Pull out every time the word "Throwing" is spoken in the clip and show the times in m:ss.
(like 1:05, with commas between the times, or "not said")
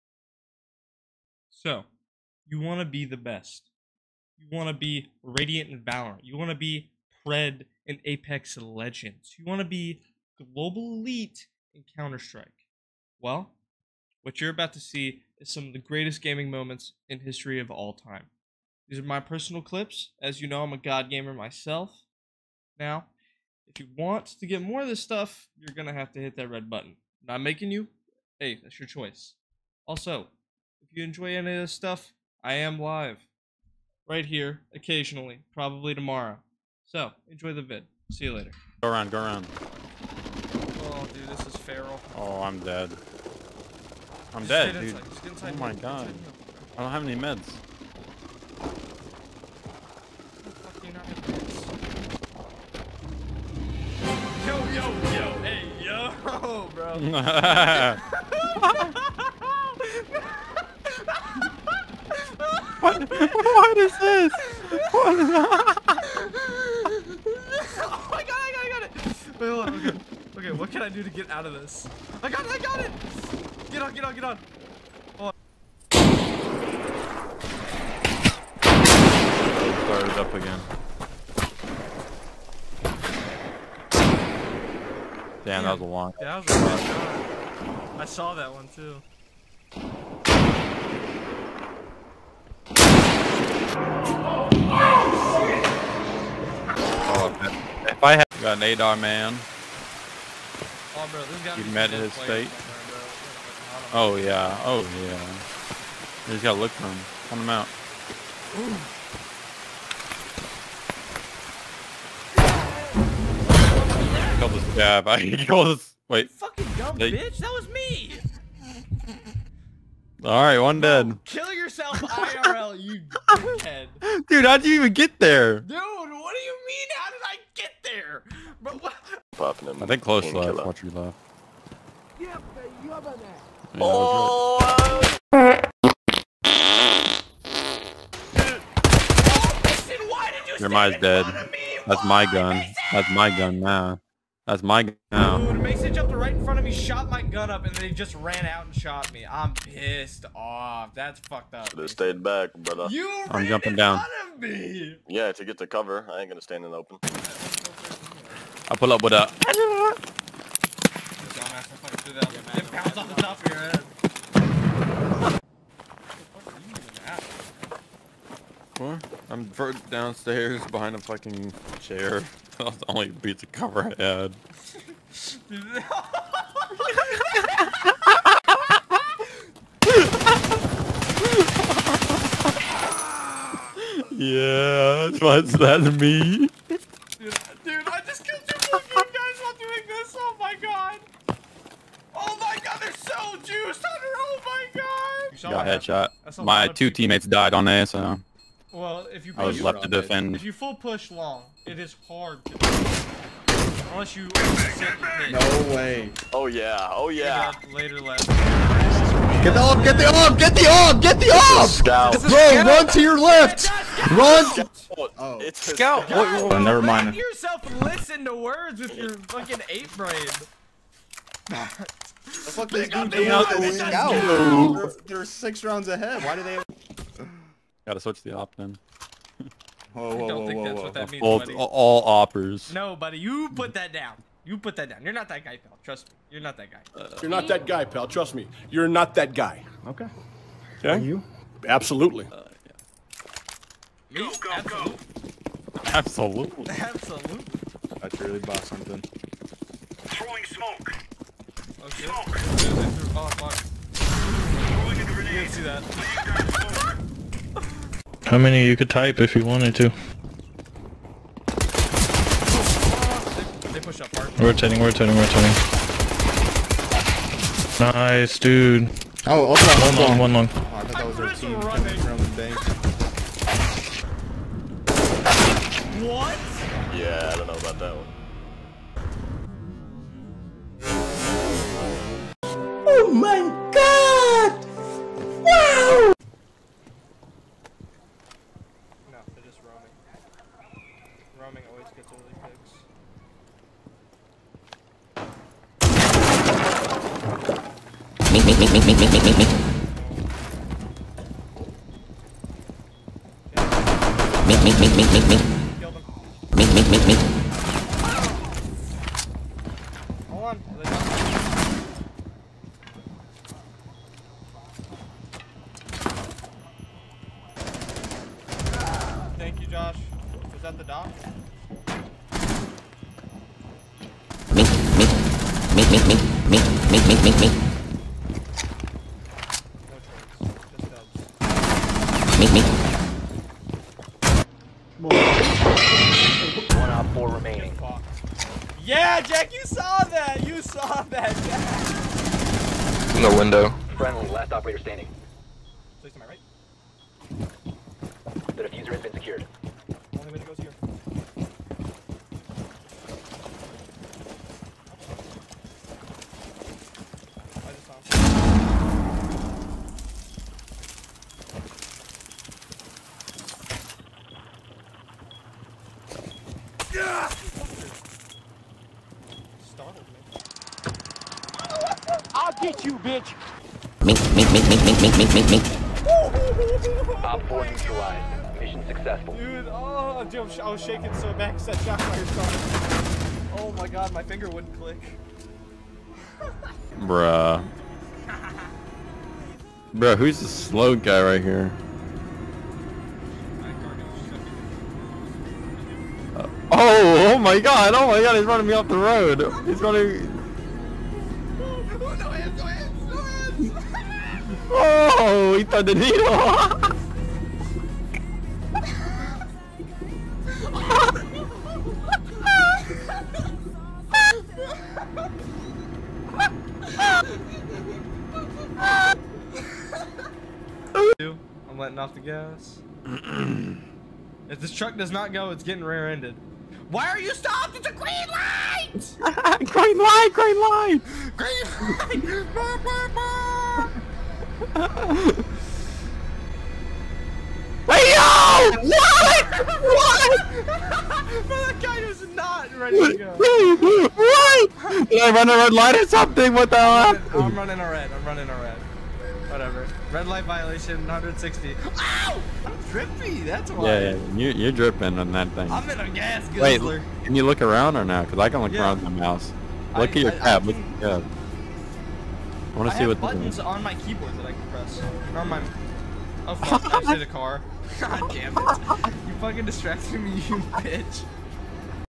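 4:09, 4:13.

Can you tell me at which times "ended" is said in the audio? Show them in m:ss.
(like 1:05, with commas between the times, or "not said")
7:05.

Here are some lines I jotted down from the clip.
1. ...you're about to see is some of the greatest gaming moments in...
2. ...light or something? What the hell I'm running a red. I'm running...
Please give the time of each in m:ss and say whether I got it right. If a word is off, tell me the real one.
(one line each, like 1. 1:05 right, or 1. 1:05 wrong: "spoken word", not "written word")
1. 0:14 right
2. 7:25 right.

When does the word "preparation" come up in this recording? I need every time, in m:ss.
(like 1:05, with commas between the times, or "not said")
not said.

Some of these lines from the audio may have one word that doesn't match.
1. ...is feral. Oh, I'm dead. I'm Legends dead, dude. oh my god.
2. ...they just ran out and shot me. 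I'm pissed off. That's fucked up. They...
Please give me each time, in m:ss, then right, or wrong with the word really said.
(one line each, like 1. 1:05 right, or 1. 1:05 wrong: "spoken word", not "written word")
1. 0:41 wrong: "Just", not "Legends"
2. 2:27 right.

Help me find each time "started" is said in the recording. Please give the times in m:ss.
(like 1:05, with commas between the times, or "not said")
1:19, 6:22.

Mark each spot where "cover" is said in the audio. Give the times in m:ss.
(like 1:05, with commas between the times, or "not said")
2:35, 2:53.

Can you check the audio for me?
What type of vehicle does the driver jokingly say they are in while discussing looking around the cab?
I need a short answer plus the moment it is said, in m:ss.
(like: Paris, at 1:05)
Gas guzzler, at 7:36.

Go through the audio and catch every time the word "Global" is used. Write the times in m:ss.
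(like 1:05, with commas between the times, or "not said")
0:10.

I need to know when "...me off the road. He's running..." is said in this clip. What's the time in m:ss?
6:38.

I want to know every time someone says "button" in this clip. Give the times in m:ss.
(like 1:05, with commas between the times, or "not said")
0:26, 7:43.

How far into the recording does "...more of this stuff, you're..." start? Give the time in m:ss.
0:24.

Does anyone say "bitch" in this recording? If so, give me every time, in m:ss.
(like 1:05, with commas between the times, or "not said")
1:57, 6:12, 7:50.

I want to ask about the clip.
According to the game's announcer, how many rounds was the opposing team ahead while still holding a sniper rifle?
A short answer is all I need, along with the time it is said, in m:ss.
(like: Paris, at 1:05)
6, at 3:45.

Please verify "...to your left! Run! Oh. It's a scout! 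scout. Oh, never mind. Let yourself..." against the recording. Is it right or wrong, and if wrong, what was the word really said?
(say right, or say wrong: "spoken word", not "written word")
right.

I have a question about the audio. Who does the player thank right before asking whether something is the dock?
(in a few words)
Josh.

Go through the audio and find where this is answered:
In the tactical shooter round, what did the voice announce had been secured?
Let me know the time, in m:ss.
5:48.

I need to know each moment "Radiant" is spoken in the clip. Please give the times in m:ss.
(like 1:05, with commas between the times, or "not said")
0:05.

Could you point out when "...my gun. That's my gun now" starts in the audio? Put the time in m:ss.
2:22.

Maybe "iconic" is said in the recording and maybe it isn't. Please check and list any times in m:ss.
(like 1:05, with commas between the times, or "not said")
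not said.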